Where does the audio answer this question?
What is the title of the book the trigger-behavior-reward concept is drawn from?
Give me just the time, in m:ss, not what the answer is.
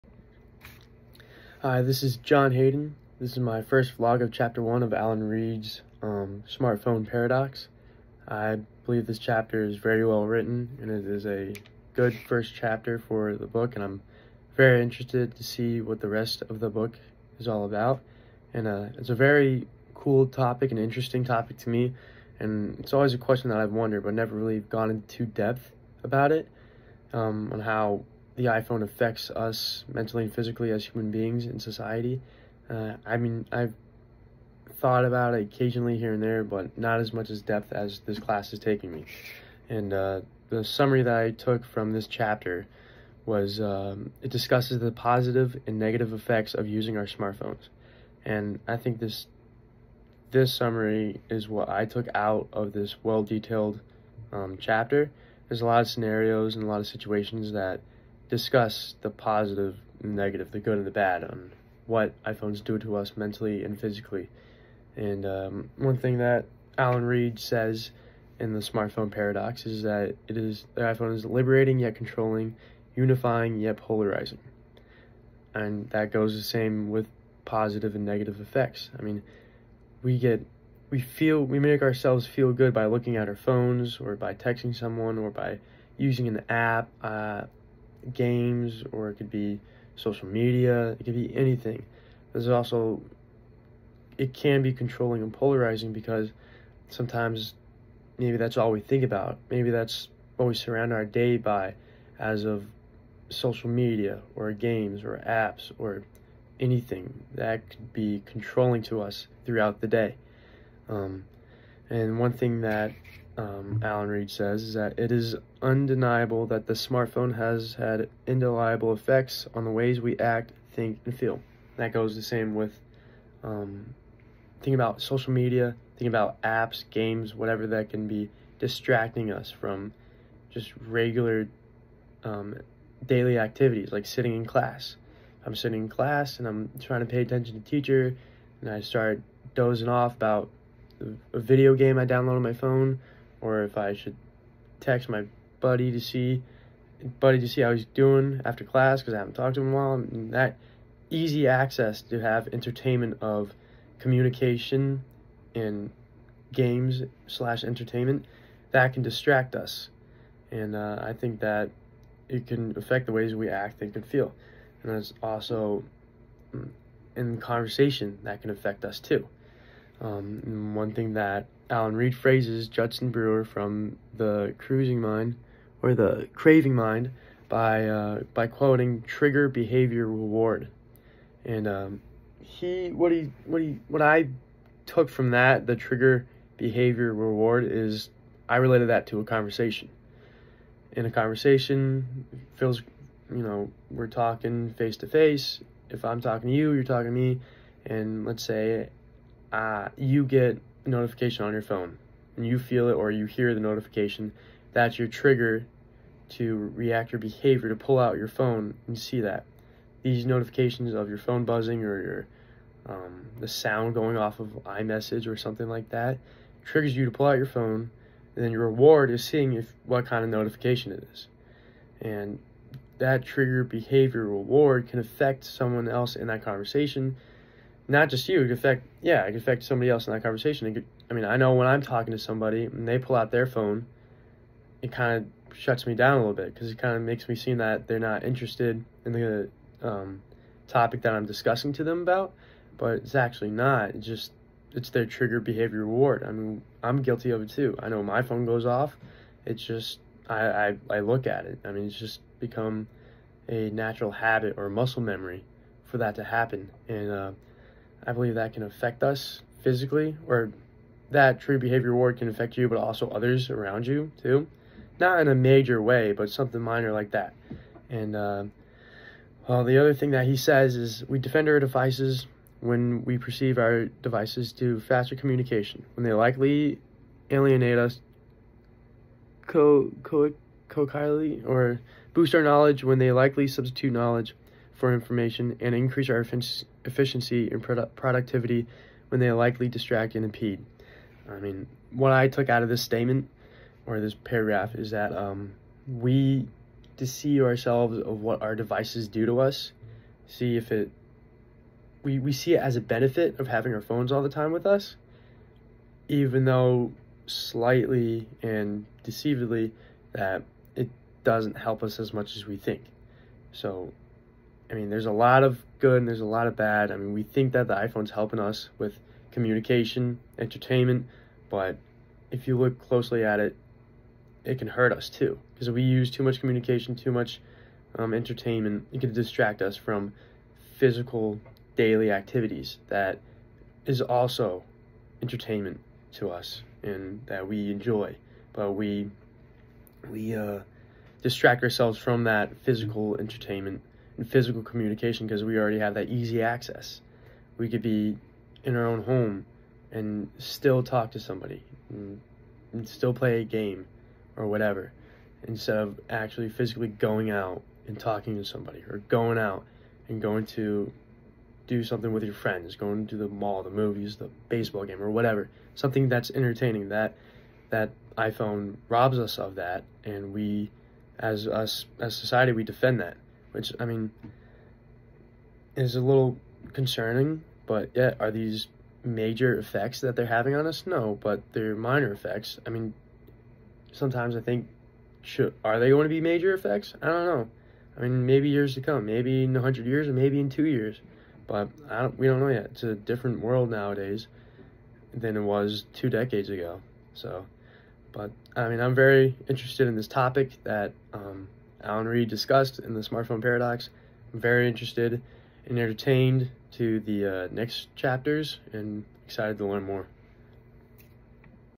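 2:55.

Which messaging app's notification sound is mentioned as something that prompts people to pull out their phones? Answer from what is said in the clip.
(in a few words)
iMessage.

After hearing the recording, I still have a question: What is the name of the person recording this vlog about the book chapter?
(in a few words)
John Hayden.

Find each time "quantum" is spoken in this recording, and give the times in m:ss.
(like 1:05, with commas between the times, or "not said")
not said.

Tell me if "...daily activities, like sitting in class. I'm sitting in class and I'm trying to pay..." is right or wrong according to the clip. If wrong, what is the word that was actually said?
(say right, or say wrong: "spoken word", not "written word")
right.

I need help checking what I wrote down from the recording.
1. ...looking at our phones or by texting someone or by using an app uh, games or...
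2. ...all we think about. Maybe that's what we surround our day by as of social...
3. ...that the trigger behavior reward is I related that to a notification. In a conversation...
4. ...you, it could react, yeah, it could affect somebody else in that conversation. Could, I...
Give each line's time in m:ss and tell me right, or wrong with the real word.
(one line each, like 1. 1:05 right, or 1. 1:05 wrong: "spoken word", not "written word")
1. 1:22 right
2. 1:38 right
3. 3:05 wrong: "conversation", not "notification"
4. 3:48 wrong: "affect", not "react".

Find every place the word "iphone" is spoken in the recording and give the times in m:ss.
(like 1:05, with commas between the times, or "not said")
0:28, 1:02, 1:10, 5:17, 6:08.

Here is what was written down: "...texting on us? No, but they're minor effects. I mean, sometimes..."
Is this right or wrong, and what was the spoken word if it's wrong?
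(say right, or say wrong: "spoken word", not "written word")
wrong: "having", not "texting".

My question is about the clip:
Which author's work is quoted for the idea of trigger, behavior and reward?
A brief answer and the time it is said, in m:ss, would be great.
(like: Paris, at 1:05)
Judson Brewer, at 2:52.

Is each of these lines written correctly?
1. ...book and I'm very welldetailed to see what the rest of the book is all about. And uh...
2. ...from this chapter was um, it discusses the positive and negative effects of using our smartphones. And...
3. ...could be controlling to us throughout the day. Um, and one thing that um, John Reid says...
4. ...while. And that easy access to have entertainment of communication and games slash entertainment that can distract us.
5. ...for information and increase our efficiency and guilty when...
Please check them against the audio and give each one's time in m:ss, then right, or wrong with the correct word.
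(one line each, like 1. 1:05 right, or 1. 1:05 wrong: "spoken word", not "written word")
1. 0:13 wrong: "interested", not "welldetailed"
2. 0:41 right
3. 1:47 wrong: "Alan", not "John"
4. 2:29 right
5. 4:44 wrong: "productivity", not "guilty".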